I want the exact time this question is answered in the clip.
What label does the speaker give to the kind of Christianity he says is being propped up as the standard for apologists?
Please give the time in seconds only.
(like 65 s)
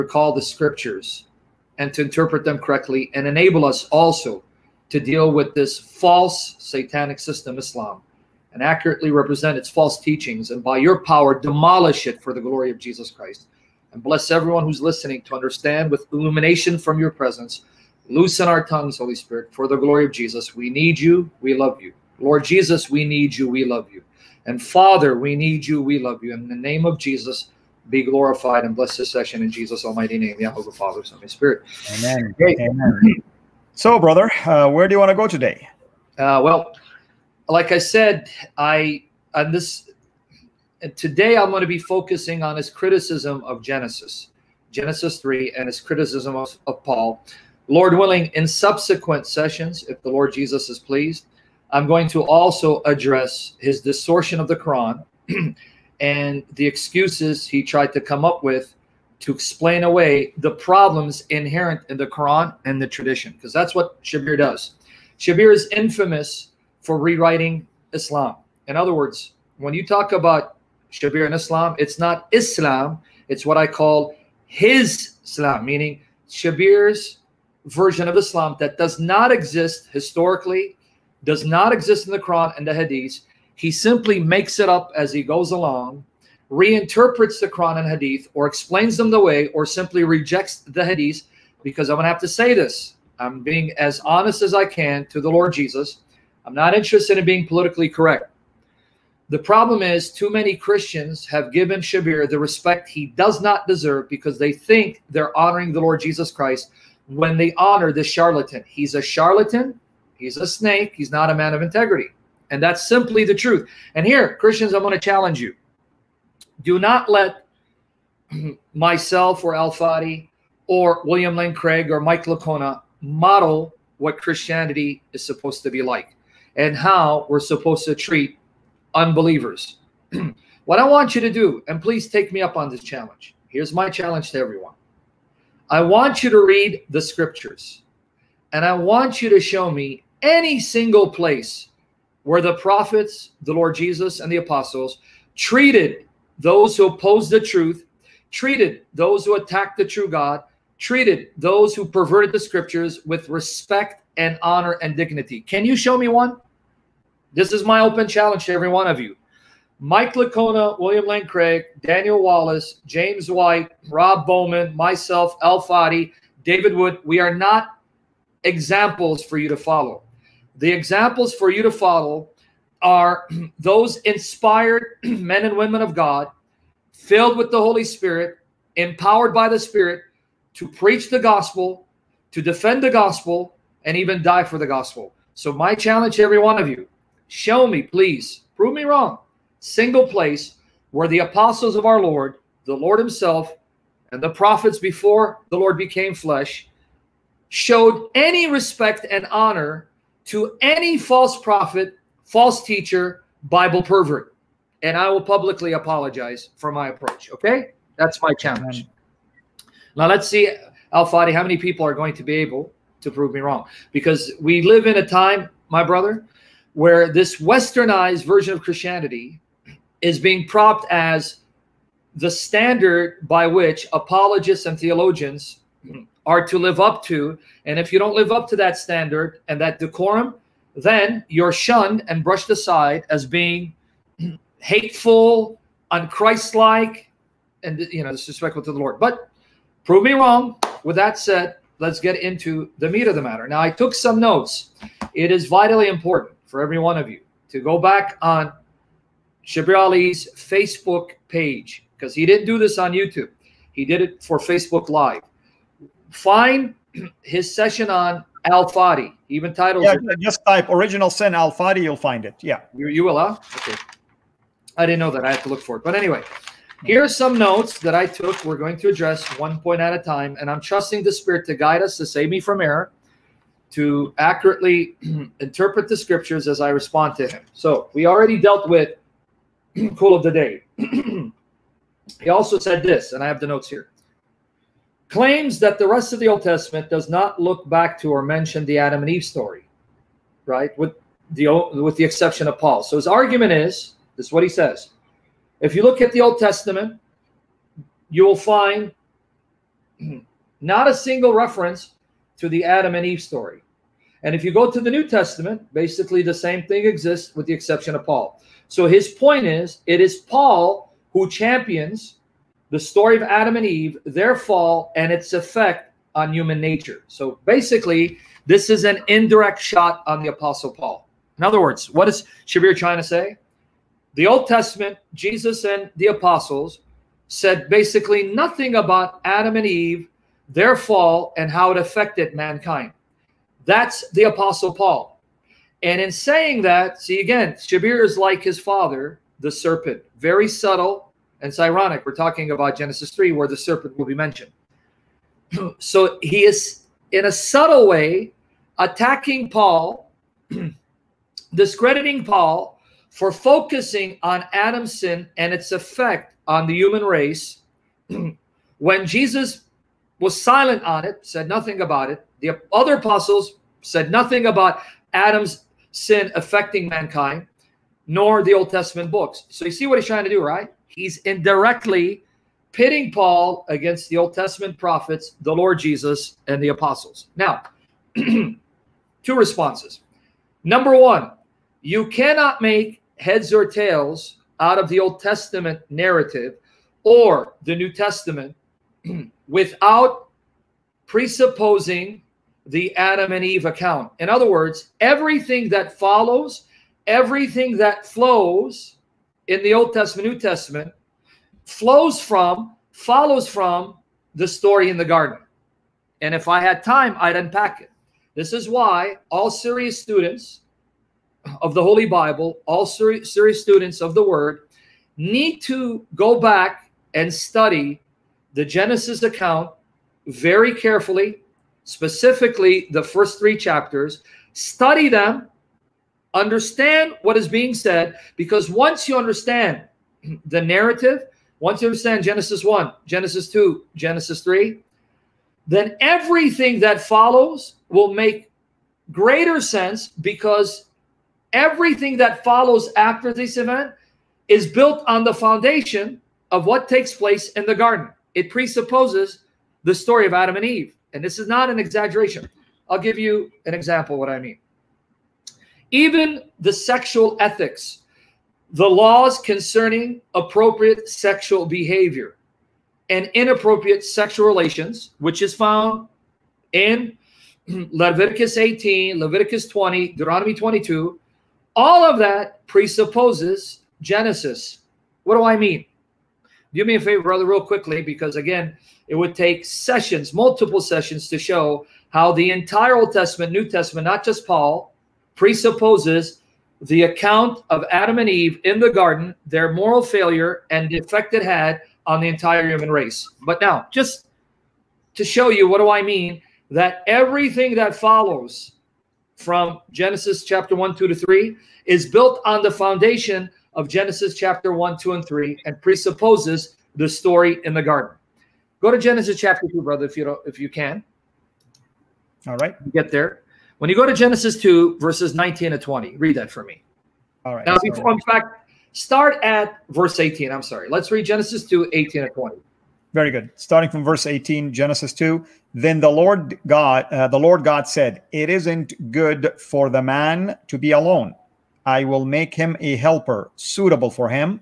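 217 s.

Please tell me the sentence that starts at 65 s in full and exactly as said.
Shabir is infamous for rewriting Islam.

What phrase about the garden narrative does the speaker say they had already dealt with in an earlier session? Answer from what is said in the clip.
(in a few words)
Cool of the day.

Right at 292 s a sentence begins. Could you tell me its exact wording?
So his argument is this: is what he says.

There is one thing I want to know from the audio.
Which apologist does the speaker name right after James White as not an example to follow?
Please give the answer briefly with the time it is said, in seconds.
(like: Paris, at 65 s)
Rob Bowman, at 163 s.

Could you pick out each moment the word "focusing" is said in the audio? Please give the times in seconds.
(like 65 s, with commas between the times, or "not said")
41 s, 353 s.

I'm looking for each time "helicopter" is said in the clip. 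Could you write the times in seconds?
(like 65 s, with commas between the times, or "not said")
not said.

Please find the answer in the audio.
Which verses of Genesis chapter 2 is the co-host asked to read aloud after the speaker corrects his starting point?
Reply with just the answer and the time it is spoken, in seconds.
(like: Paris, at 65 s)
Genesis 2:18-20, at 521 s.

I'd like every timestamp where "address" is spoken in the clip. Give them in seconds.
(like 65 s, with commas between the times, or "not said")
52 s, 268 s.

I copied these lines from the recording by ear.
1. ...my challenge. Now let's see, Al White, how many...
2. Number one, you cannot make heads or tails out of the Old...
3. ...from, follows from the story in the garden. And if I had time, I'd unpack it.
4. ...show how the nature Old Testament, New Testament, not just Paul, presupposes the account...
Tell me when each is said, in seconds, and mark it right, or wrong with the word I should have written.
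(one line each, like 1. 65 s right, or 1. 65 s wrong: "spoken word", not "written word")
1. 208 s wrong: "Fadi", not "White"
2. 380 s right
3. 402 s right
4. 481 s wrong: "entire", not "nature".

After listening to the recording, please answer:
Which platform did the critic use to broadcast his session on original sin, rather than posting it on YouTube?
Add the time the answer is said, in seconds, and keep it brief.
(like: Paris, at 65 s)
Facebook Live, at 254 s.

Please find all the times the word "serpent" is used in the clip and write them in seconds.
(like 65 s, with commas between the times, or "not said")
339 s, 343 s.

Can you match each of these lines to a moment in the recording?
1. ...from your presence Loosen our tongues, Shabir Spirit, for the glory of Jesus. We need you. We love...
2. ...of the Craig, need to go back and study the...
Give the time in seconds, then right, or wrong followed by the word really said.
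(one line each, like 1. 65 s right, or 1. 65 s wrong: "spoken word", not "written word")
1. 16 s wrong: "Holy", not "Shabir"
2. 414 s wrong: "Word", not "Craig".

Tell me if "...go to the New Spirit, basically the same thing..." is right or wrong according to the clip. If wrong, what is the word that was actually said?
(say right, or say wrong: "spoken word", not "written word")
wrong: "Testament", not "Spirit".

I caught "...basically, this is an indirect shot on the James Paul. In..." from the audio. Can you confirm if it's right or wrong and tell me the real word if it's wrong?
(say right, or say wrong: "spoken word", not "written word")
wrong: "Apostle", not "James".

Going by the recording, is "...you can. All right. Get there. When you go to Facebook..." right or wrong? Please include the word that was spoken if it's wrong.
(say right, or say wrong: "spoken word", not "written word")
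wrong: "Genesis", not "Facebook".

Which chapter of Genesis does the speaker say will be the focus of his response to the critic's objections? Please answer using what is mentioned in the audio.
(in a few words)
Genesis 3.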